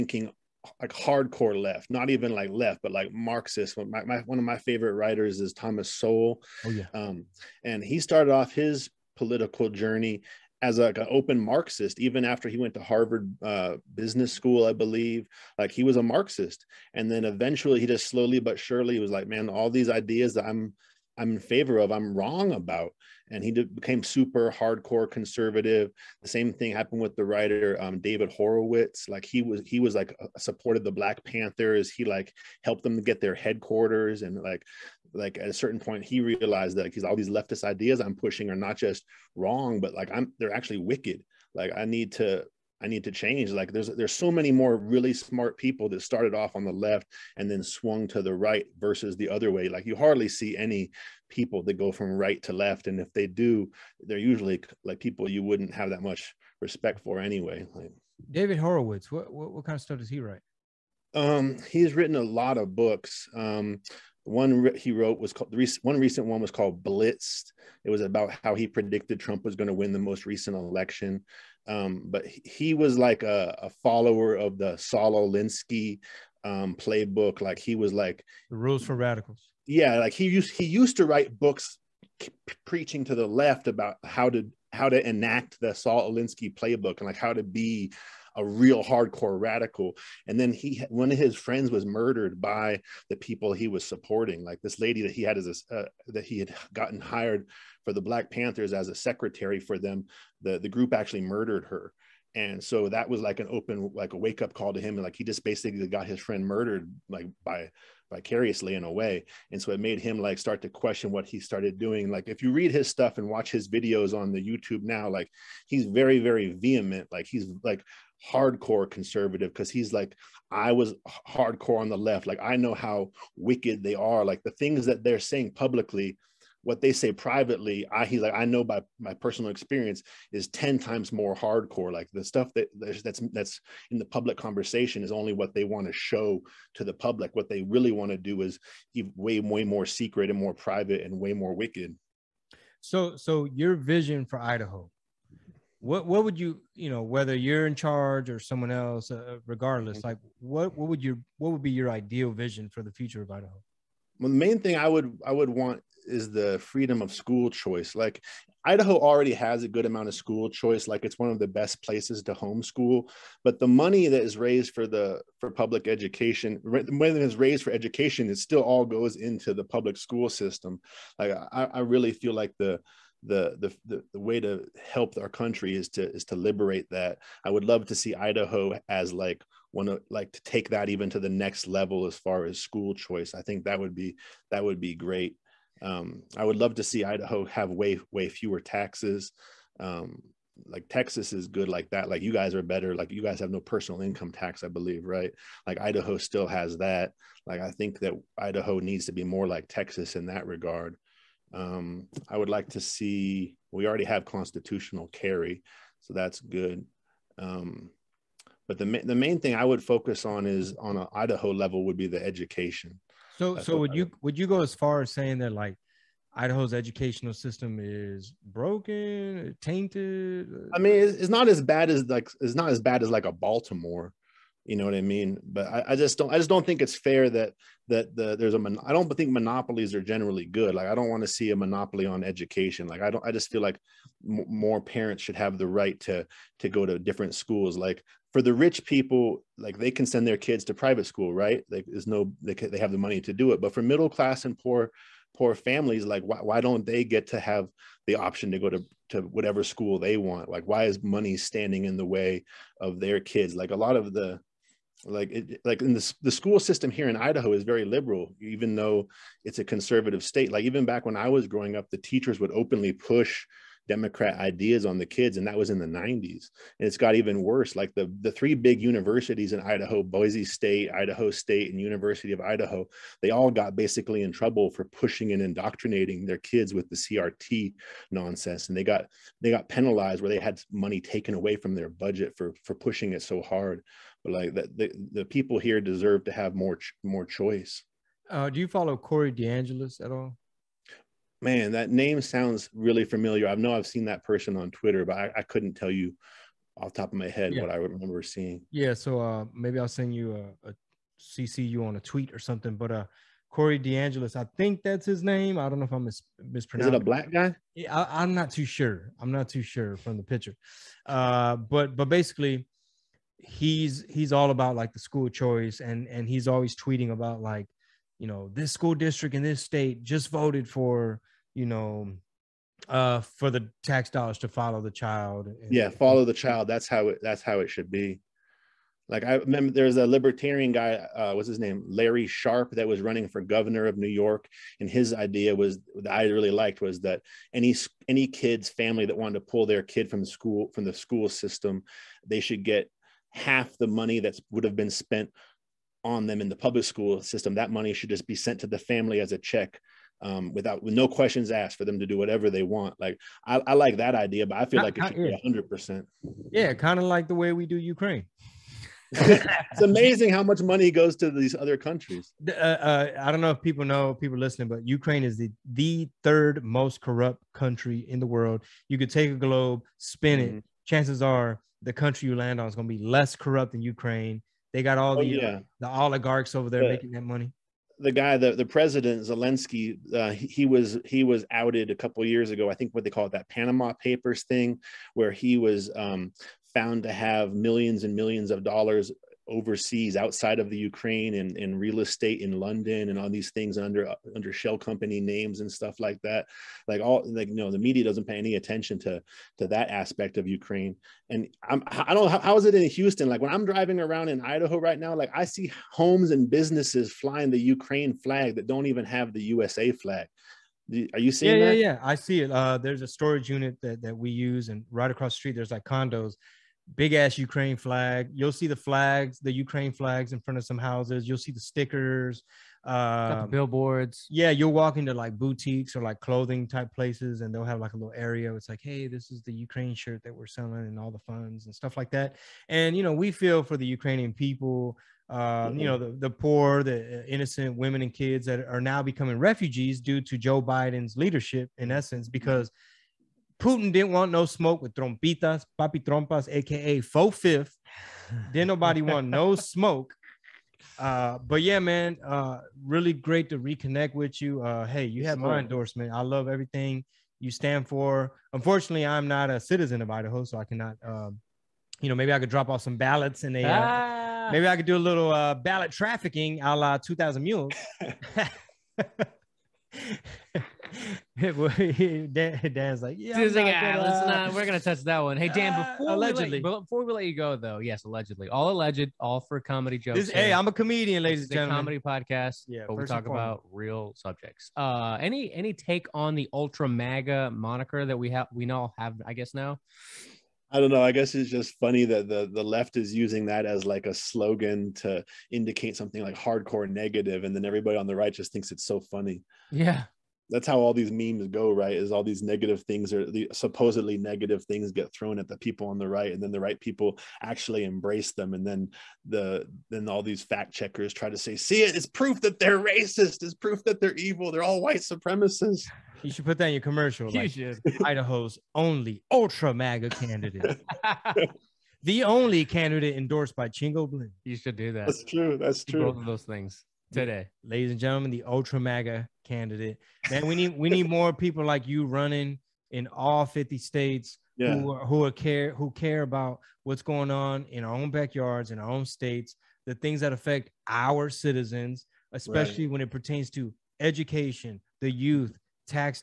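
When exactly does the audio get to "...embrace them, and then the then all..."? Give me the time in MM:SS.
08:27.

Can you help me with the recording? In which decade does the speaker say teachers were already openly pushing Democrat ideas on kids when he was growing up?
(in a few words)
the 90s.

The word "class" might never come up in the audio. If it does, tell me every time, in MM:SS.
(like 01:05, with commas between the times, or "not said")
04:04.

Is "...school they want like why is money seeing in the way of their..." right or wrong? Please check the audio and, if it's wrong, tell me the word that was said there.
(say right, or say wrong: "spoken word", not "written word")
wrong: "standing", not "seeing".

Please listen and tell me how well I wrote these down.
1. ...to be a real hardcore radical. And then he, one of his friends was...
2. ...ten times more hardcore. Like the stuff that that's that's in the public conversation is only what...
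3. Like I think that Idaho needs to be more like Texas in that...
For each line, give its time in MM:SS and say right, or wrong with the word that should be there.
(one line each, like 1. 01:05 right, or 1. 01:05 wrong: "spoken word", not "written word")
1. 01:27 right
2. 02:10 right
3. 03:17 right.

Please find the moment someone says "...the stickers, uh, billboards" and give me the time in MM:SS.
07:01.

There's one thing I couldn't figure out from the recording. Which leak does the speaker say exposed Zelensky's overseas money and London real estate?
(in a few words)
Panama Papers.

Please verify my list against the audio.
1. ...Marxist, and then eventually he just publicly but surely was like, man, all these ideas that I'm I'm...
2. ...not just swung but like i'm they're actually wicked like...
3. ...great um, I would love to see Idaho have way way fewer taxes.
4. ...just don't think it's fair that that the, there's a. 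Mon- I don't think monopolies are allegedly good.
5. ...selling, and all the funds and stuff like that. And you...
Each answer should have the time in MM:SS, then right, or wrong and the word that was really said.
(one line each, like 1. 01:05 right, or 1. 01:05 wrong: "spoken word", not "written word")
1. 00:16 wrong: "slowly", not "publicly"
2. 00:38 wrong: "wrong", not "swung"
3. 03:04 right
4. 03:46 wrong: "generally", not "allegedly"
5. 07:10 right.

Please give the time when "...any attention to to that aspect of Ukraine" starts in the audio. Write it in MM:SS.
06:38.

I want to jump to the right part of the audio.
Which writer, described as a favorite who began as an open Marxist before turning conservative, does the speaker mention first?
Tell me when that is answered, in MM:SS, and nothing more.
00:05.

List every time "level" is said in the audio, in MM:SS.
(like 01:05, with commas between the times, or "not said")
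03:01, 03:31.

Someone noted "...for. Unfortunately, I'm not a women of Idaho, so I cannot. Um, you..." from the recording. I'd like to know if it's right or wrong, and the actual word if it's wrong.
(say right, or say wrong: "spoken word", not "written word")
wrong: "citizen", not "women".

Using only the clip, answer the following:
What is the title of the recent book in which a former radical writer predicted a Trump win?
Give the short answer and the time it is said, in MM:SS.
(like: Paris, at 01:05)
Blitzed, at 01:06.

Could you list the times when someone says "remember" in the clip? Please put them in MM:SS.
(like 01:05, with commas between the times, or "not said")
04:57, 05:29.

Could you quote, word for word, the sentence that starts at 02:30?
like what what would your what would be your ideal vision for the future of Idaho?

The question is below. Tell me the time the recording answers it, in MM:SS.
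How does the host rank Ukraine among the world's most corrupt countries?
06:06.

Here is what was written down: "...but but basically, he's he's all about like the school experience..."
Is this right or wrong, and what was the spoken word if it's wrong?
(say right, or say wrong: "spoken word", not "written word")
wrong: "choice", not "experience".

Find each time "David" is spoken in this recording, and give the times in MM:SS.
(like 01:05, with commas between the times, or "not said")
00:27, 00:58.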